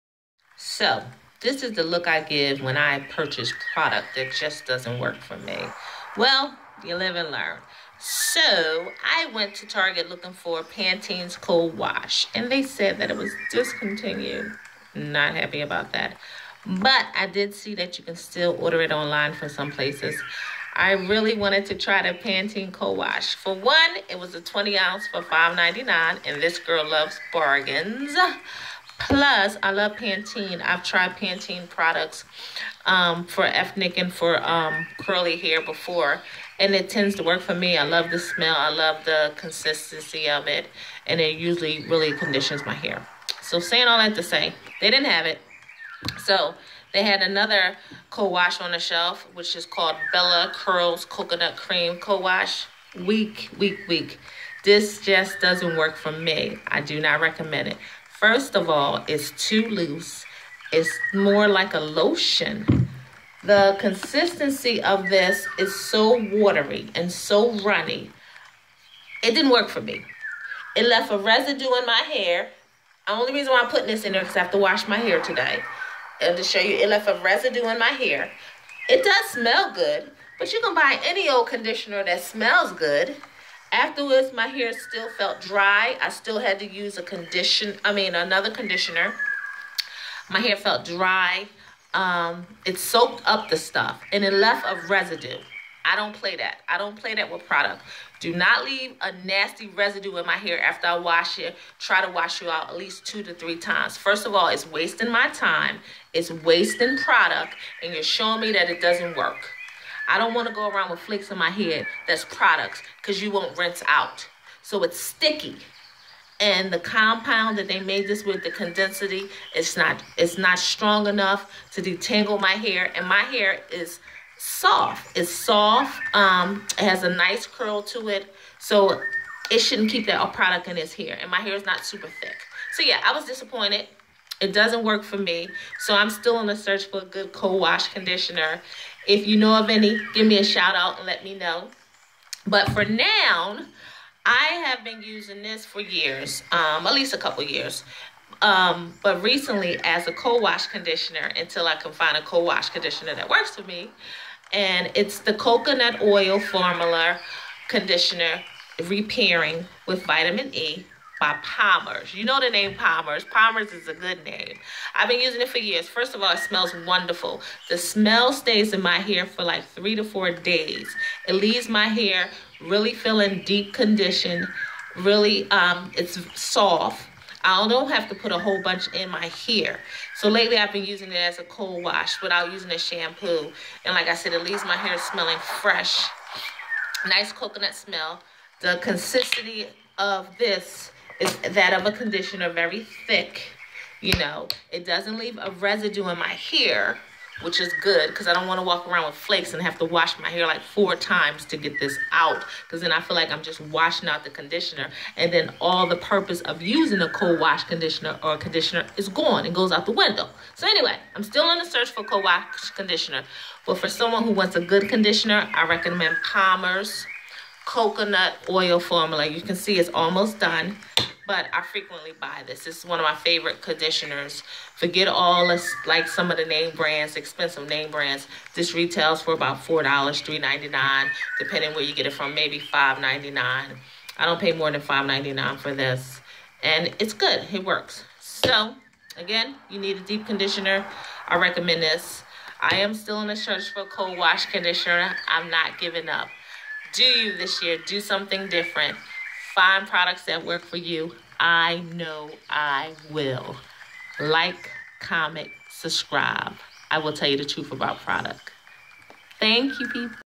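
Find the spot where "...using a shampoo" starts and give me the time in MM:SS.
03:02.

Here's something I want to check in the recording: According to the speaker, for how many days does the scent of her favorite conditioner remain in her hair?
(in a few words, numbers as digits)
3 to 4 days.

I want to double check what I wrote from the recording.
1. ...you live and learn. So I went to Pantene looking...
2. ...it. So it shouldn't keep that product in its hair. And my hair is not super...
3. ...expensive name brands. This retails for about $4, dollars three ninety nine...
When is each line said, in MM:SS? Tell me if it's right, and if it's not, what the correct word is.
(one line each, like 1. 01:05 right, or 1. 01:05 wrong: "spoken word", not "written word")
1. 00:06 wrong: "Target", not "Pantene"
2. 02:08 right
3. 03:47 right.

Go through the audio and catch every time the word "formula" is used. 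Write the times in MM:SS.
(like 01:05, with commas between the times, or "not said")
02:36, 03:38.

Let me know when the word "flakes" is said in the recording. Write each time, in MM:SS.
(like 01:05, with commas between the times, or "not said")
01:50, 03:19.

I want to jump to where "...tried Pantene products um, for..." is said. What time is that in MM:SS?
00:30.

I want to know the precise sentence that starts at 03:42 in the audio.
This is one of my favorite conditioners.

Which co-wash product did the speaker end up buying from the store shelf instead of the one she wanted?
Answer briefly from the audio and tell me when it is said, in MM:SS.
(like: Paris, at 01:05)
Bella Curls Coconut Cream Co-Wash, at 00:50.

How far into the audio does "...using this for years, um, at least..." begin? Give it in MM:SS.
02:25.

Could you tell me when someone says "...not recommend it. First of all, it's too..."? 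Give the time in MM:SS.
00:56.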